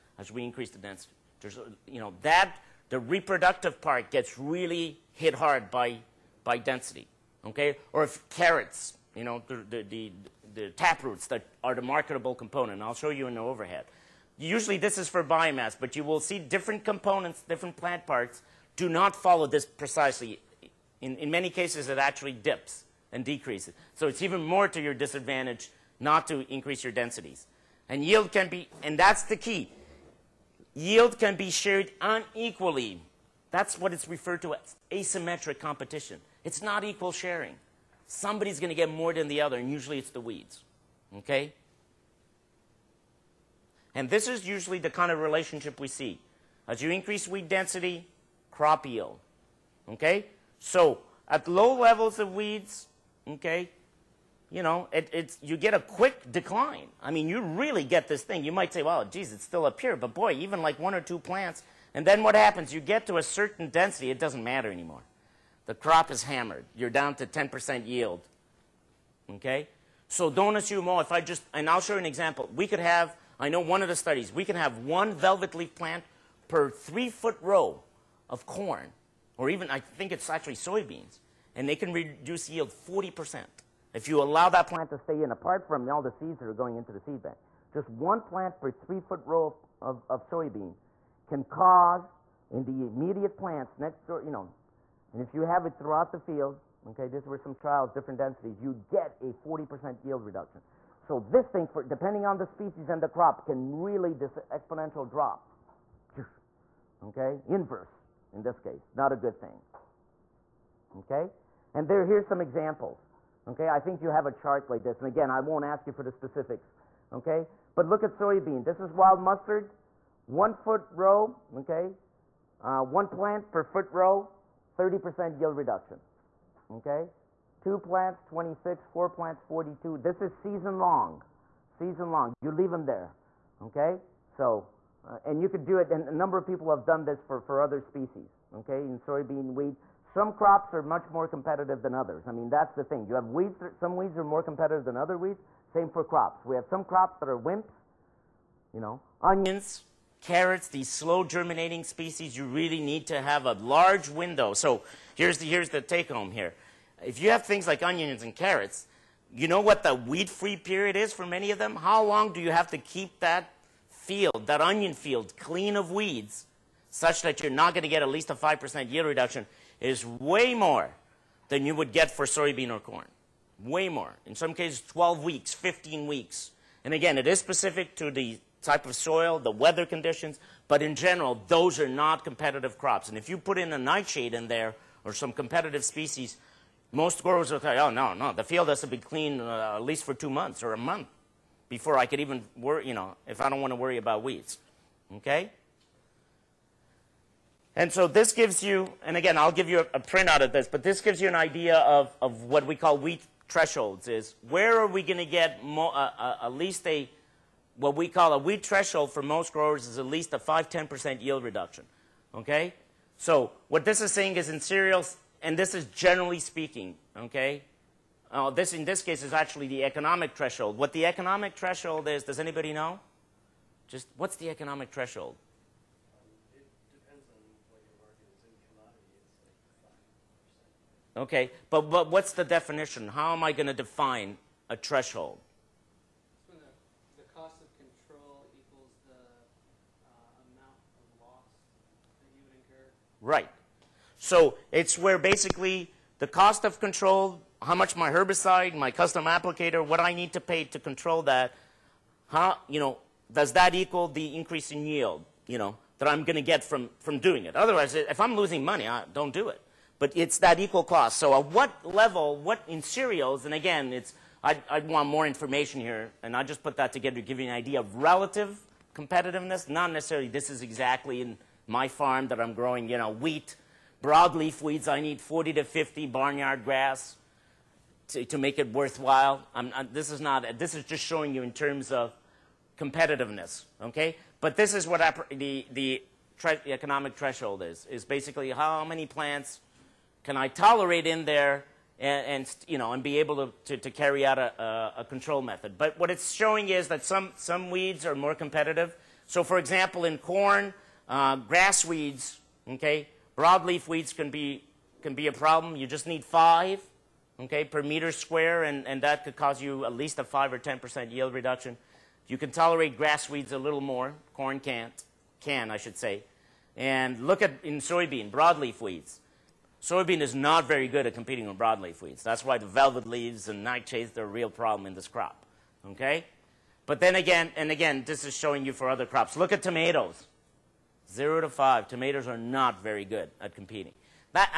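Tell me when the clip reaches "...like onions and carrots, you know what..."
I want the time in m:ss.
2:37.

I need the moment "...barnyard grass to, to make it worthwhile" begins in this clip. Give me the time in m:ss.
4:36.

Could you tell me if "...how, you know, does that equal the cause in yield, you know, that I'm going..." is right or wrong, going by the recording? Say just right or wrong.
wrong.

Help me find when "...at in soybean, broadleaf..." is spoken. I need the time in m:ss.
5:17.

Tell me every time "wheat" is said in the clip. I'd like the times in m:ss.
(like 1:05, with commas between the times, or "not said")
2:19, 4:33.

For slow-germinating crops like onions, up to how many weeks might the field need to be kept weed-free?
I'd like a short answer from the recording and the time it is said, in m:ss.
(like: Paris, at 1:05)
15 weeks, at 2:55.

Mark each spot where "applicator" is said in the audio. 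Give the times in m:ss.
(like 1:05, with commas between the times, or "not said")
4:09.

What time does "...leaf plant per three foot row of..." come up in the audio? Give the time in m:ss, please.
1:15.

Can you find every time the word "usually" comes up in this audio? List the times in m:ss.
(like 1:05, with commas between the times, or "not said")
0:14, 0:39, 0:44.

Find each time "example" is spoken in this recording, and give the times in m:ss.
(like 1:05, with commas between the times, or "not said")
1:12, 1:52, 4:59.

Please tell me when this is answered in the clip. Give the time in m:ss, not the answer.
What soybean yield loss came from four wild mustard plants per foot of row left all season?
2:09.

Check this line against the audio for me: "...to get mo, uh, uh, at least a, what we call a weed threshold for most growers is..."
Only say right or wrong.
right.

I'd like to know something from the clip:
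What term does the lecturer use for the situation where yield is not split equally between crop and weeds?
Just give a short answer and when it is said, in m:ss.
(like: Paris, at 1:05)
asymmetric competition, at 0:34.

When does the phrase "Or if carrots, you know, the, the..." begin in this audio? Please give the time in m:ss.
0:07.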